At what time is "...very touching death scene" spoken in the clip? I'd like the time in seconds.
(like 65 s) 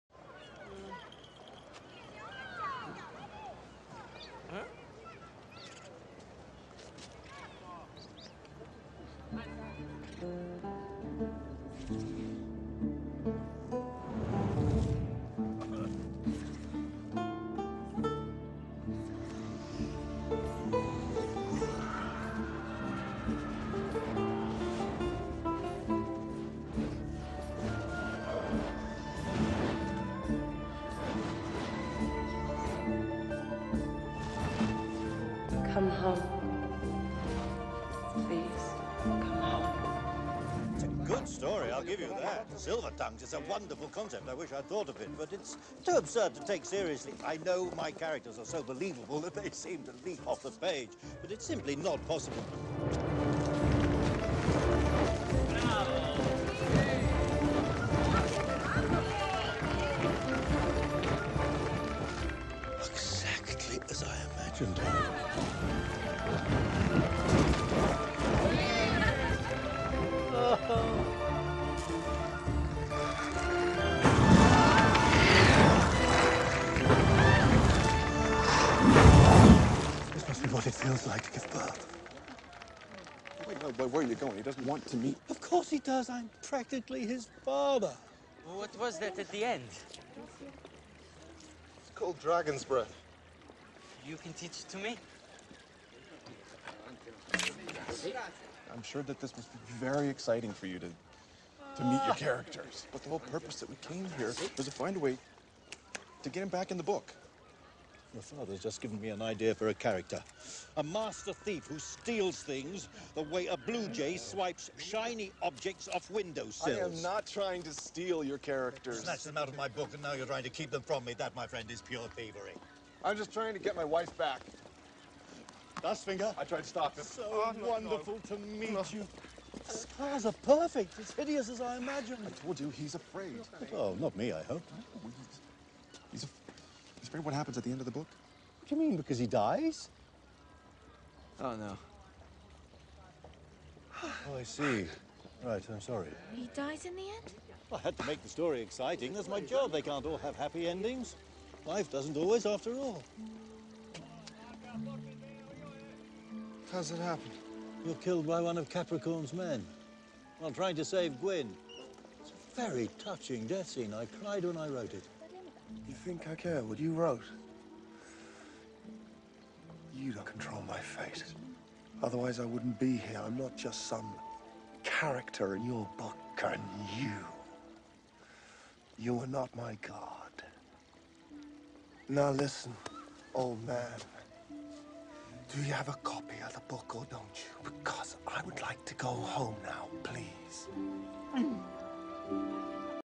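162 s.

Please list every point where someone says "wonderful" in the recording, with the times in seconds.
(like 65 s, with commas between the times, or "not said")
43 s, 127 s.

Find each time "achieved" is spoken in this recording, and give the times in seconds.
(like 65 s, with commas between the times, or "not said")
not said.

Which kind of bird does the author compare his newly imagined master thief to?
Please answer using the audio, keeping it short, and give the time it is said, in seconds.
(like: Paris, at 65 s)
Blue jay, at 113 s.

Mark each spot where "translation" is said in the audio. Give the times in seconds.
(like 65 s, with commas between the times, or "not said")
not said.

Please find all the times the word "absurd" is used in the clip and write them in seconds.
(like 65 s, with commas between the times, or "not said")
45 s.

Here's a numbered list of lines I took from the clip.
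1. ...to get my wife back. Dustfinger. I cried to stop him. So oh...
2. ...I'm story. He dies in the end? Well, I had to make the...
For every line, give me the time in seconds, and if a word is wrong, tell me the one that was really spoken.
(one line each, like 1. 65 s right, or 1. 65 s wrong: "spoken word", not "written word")
1. 123 s wrong: "tried", not "cried"
2. 145 s wrong: "sorry", not "story".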